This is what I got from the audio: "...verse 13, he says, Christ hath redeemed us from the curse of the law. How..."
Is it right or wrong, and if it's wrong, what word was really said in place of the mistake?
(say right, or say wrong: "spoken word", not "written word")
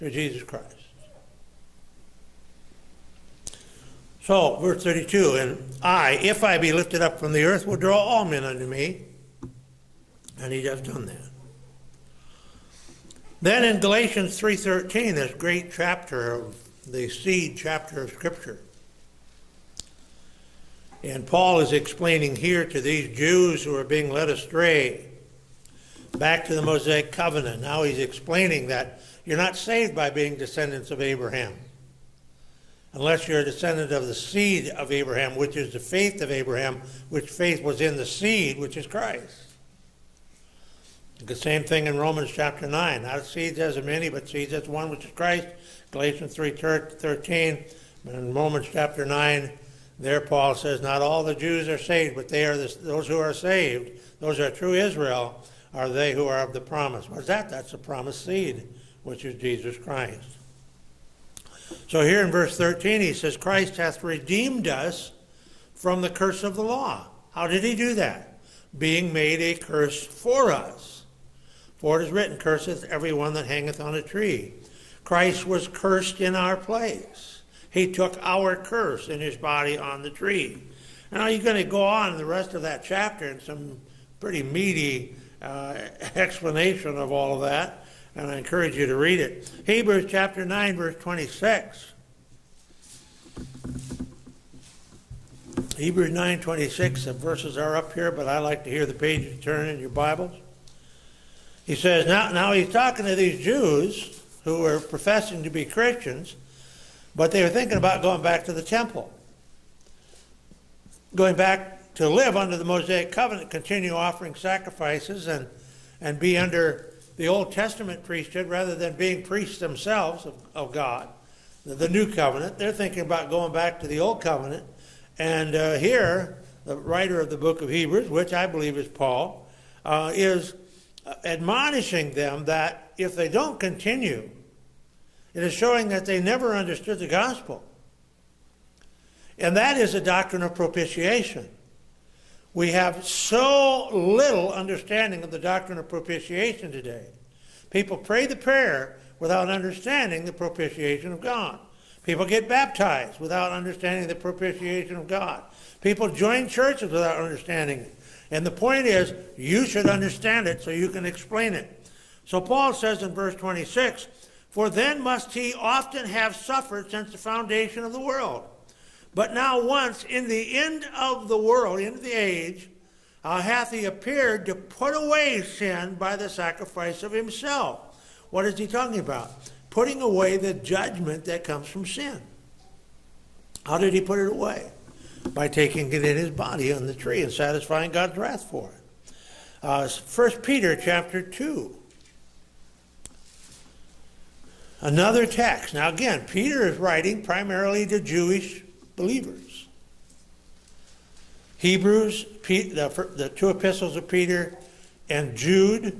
right.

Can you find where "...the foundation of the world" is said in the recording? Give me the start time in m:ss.
2:47.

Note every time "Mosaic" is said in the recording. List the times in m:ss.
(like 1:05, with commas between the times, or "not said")
0:26, 1:52.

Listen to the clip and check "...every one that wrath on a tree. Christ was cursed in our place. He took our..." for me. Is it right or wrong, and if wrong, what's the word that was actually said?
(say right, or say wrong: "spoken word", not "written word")
wrong: "hangeth", not "wrath".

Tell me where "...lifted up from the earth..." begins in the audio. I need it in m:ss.
0:06.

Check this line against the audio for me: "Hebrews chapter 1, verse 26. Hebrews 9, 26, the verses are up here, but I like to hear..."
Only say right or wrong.
wrong.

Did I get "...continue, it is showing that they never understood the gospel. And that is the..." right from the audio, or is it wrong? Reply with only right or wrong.
right.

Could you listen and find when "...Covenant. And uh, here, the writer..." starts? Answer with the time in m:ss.
2:04.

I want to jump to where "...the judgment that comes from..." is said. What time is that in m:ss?
3:00.